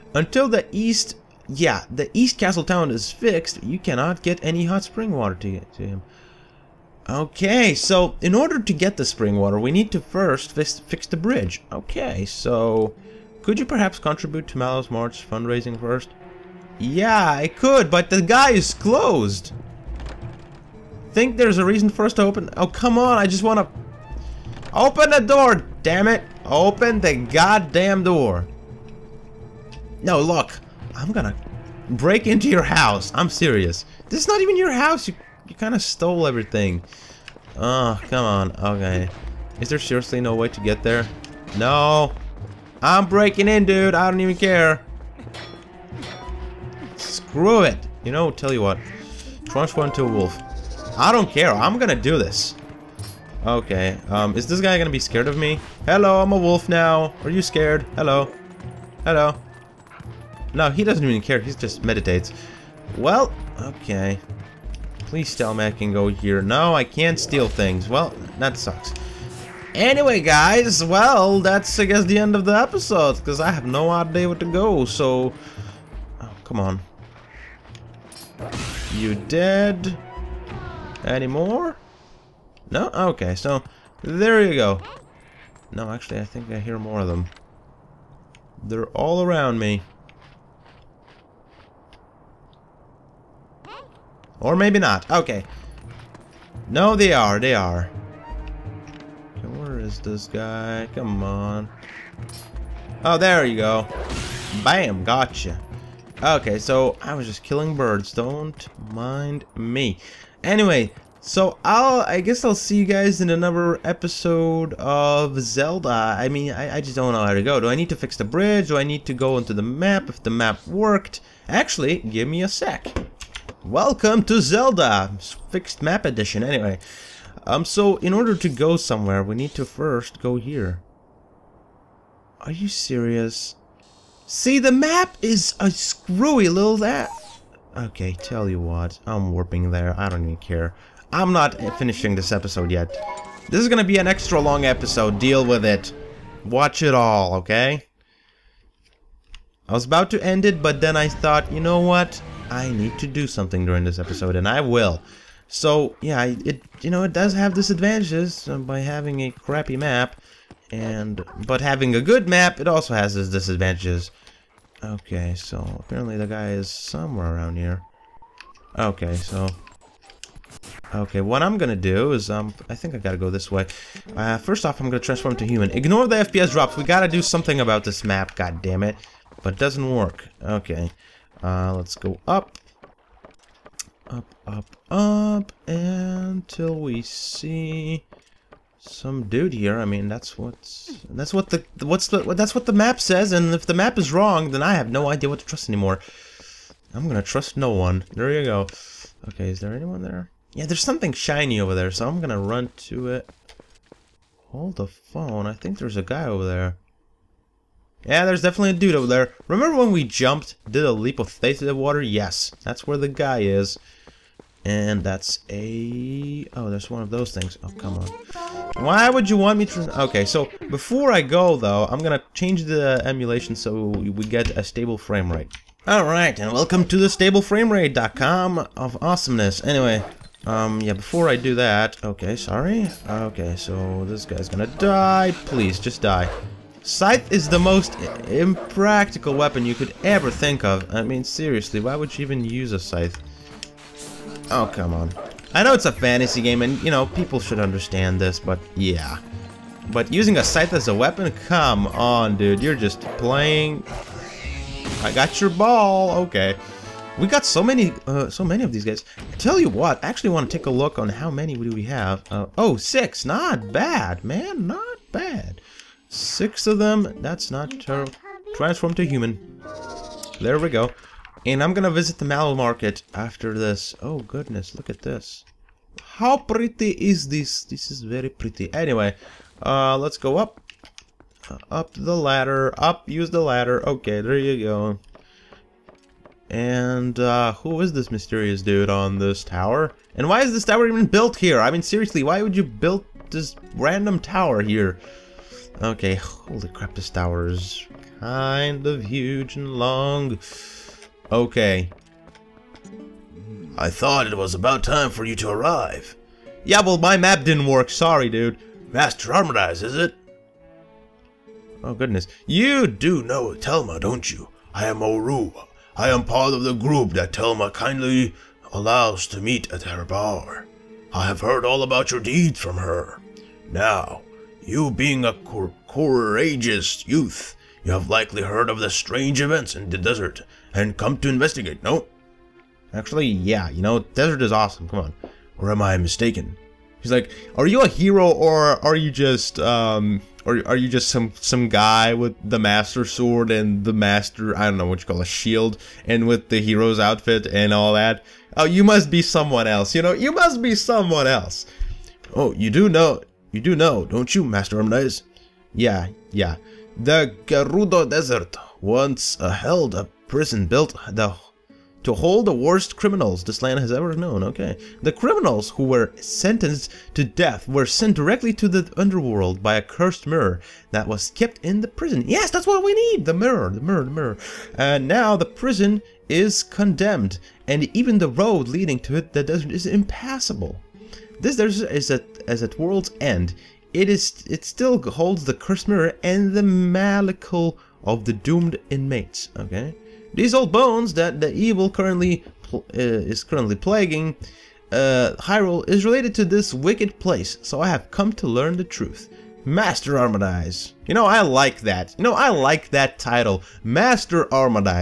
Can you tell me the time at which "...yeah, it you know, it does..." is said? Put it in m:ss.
2:36.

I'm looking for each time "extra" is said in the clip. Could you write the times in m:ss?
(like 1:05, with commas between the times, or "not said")
2:24.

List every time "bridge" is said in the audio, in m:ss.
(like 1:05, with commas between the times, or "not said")
0:11, 1:58.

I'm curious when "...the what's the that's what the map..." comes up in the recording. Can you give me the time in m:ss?
3:11.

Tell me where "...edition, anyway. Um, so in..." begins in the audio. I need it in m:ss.
2:06.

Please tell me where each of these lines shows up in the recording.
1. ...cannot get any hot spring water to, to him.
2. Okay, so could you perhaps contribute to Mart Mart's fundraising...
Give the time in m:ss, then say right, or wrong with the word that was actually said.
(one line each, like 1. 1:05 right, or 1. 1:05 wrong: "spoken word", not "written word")
1. 0:03 right
2. 0:11 wrong: "Malo", not "Mart".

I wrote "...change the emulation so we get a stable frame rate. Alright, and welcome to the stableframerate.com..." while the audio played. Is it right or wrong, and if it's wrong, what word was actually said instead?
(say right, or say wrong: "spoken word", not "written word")
right.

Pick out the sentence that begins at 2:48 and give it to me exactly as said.
Okay, so Okay, what I'm gonna do is, um, I think I gotta go this way.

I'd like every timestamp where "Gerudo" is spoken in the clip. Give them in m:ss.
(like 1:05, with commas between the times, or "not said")
5:57.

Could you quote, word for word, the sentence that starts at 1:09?
Anyway, guys, well, that's, I guess, the end of the episode, because I have no idea where to go, so...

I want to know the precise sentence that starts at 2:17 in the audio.
Okay, tell you what, I'm warping there.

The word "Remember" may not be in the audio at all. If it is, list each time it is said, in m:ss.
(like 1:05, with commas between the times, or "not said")
3:29.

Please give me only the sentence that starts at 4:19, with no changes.
I tell you what, I actually want to take a look on how many do we have.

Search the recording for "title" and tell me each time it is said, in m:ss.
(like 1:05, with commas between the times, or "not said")
6:43.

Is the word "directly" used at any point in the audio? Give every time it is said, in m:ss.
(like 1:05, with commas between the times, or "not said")
6:08.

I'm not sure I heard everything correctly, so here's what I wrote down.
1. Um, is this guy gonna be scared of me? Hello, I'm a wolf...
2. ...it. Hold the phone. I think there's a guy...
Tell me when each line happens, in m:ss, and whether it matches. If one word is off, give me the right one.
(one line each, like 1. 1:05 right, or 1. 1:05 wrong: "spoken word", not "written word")
1. 0:54 right
2. 3:23 right.